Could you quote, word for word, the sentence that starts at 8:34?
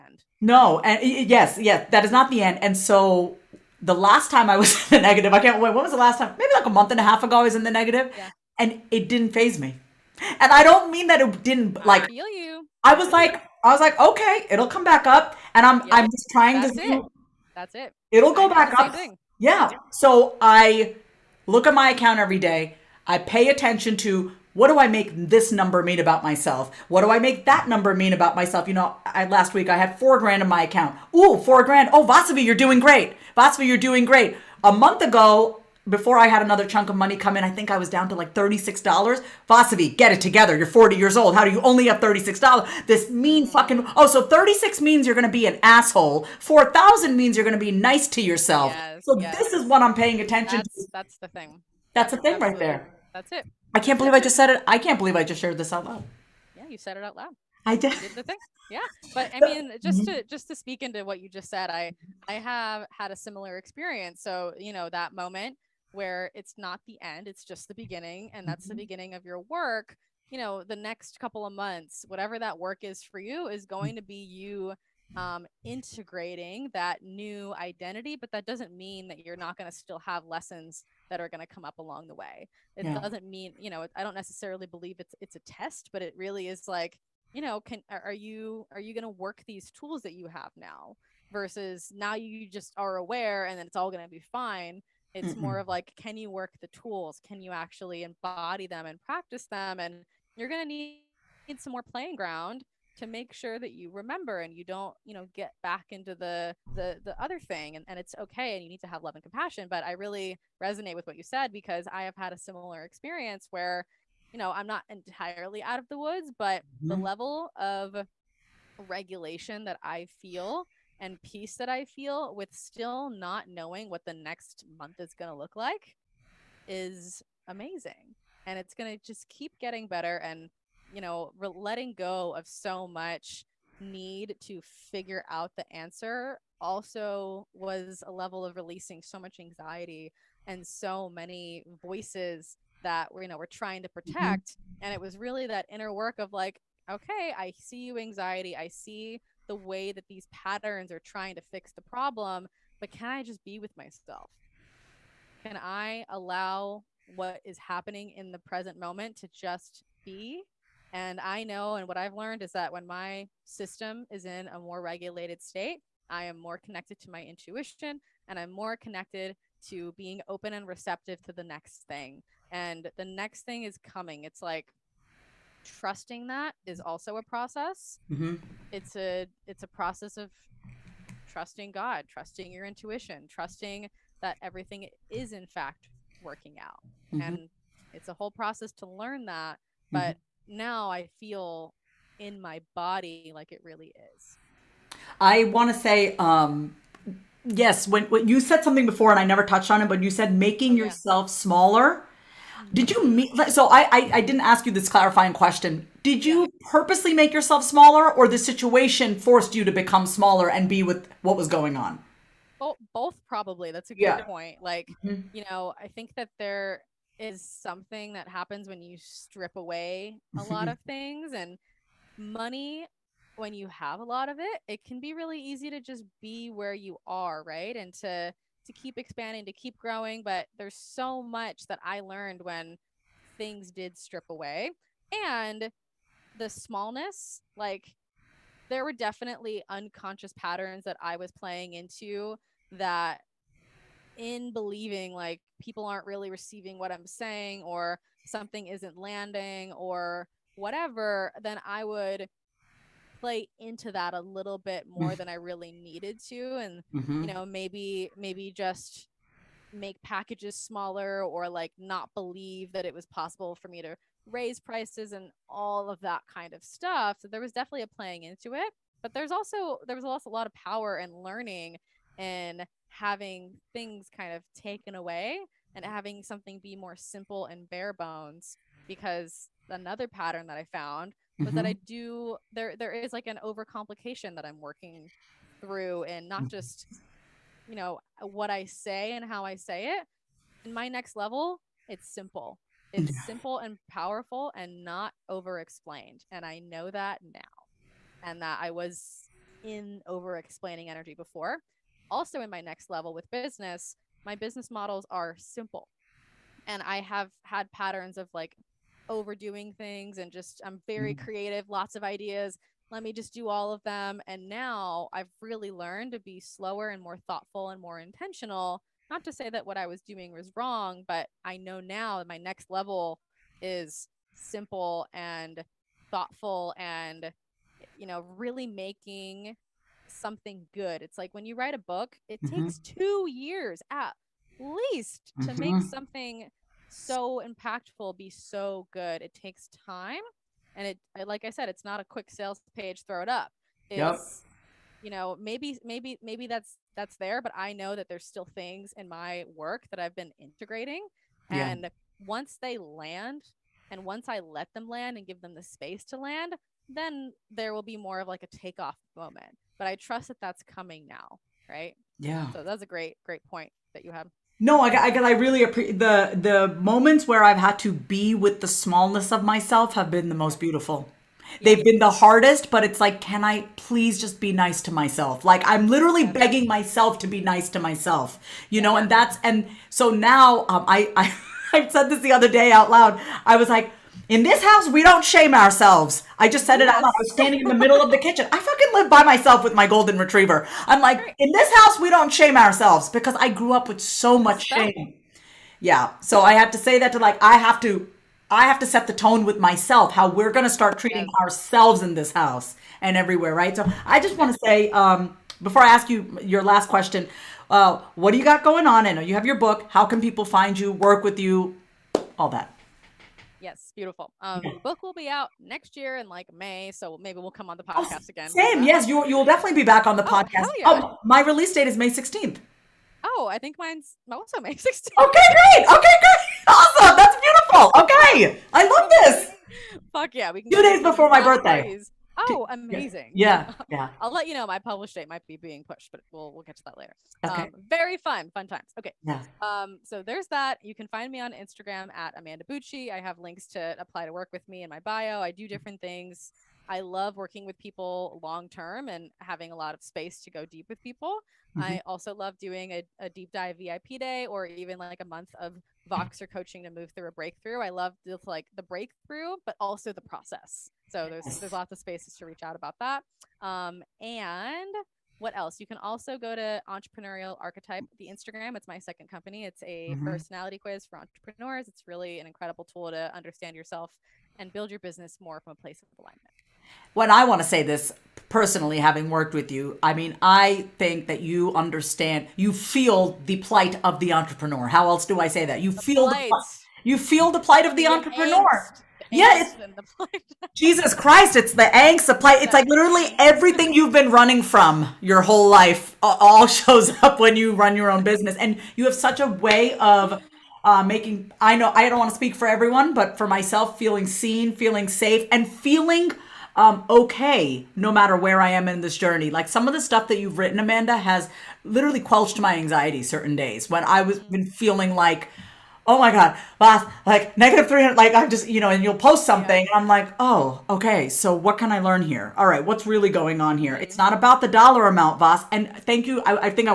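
been feeling like, oh my god boss!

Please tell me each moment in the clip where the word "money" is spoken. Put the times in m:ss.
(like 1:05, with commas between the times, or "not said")
0:36, 3:42.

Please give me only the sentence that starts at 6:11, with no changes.
They've been the hardest, but it's like, can I please just be nice to myself?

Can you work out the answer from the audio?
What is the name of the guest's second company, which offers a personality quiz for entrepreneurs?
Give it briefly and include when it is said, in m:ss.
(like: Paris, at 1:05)
Entrepreneurial Archetype, at 7:46.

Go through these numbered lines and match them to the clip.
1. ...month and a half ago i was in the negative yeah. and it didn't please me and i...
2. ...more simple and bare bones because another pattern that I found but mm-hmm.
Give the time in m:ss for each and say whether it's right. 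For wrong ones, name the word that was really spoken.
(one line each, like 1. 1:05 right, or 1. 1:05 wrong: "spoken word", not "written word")
1. 0:06 wrong: "phase", not "please"
2. 4:36 right.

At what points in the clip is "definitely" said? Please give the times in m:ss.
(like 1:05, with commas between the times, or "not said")
3:58, 4:27, 6:59.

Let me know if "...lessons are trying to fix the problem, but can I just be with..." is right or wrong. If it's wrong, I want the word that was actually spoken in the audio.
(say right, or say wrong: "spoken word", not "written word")
wrong: "patterns", not "lessons".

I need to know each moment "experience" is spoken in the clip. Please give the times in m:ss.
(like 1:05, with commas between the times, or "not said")
1:03, 1:52.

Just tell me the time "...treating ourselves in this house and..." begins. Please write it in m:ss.
6:40.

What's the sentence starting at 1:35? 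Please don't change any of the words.
It's more of like, can you work the tools?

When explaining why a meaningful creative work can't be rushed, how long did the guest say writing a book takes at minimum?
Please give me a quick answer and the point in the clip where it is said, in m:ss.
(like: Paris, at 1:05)
2 years, at 5:32.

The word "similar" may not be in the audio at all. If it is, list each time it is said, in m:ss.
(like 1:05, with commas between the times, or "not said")
1:03, 1:52.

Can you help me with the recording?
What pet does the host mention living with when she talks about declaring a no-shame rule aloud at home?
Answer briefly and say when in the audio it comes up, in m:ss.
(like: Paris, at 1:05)
golden retriever, at 6:29.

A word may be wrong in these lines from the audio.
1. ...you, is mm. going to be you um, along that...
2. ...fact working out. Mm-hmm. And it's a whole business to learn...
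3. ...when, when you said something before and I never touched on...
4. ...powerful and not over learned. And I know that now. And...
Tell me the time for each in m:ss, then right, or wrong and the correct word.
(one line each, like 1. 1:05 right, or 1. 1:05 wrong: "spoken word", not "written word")
1. 1:13 wrong: "integrating", not "along"
2. 3:05 wrong: "process", not "business"
3. 3:17 right
4. 4:53 wrong: "explained", not "learned".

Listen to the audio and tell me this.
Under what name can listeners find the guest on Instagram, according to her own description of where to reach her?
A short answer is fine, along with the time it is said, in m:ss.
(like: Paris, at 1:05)
Amanda Bucci, at 7:22.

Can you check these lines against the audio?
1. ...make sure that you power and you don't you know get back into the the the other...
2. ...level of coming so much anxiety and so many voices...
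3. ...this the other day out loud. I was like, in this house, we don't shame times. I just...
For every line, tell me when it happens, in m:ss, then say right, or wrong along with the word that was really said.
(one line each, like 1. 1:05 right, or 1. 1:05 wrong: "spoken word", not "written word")
1. 1:43 wrong: "remember", not "power"
2. 2:18 wrong: "releasing", not "coming"
3. 6:22 wrong: "ourselves", not "times".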